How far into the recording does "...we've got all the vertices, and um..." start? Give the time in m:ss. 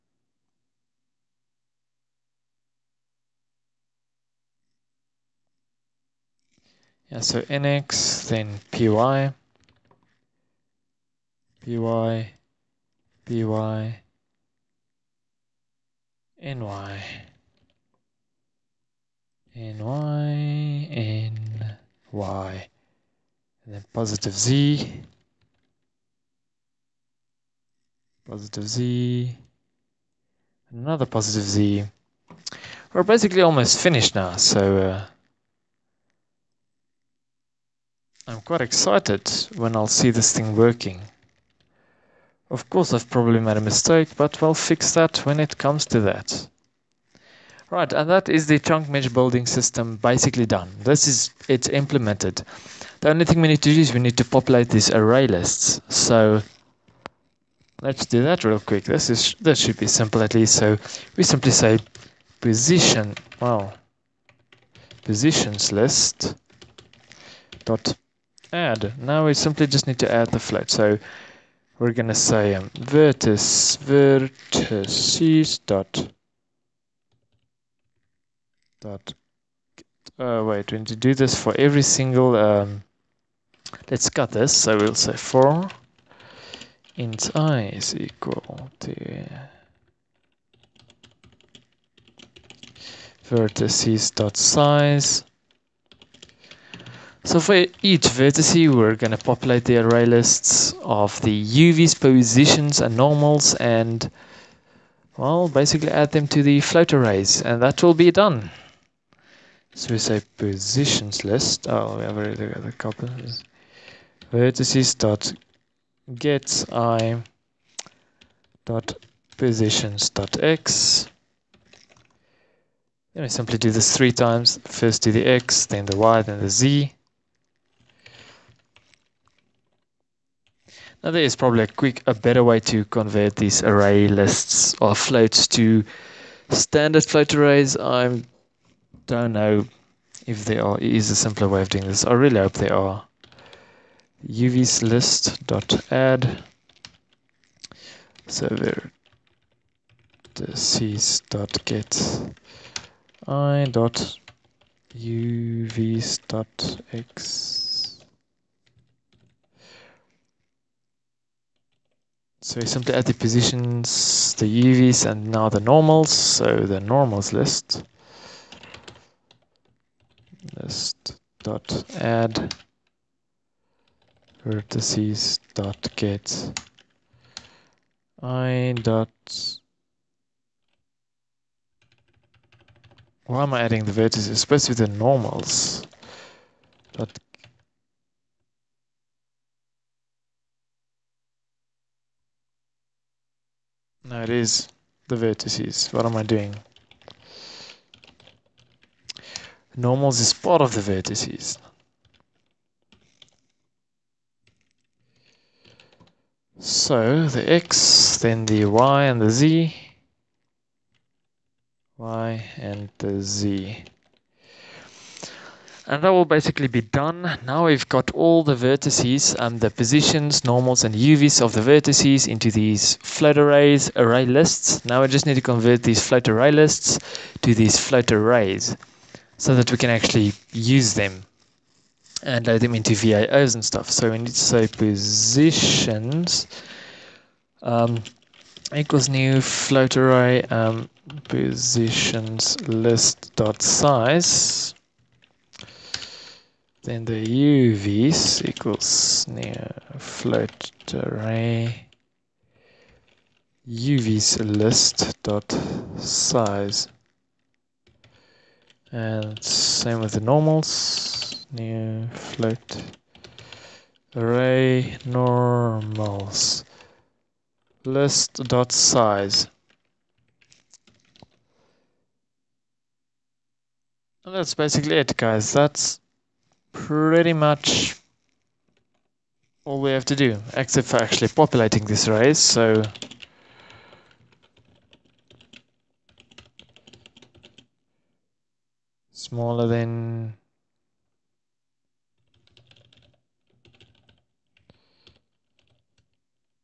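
3:37.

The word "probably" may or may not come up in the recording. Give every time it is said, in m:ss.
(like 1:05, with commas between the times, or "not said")
0:43, 2:11.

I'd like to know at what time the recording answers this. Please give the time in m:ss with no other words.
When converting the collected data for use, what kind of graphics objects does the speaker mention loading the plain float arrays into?
3:52.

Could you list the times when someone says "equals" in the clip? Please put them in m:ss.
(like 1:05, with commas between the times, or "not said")
1:27, 3:58, 4:08.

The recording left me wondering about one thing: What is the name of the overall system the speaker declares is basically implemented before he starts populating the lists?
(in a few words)
Chunk mesh building system.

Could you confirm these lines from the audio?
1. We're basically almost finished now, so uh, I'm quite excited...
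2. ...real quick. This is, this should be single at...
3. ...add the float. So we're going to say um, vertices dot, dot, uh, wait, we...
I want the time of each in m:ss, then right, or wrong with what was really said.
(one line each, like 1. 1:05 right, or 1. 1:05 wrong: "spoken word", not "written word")
1. 0:32 right
2. 0:58 wrong: "simple", not "single"
3. 1:10 right.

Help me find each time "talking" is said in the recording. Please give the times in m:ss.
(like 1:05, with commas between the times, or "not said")
not said.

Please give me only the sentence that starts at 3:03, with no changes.
Why am I adding the vertices?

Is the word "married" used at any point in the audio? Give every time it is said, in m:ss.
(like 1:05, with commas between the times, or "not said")
not said.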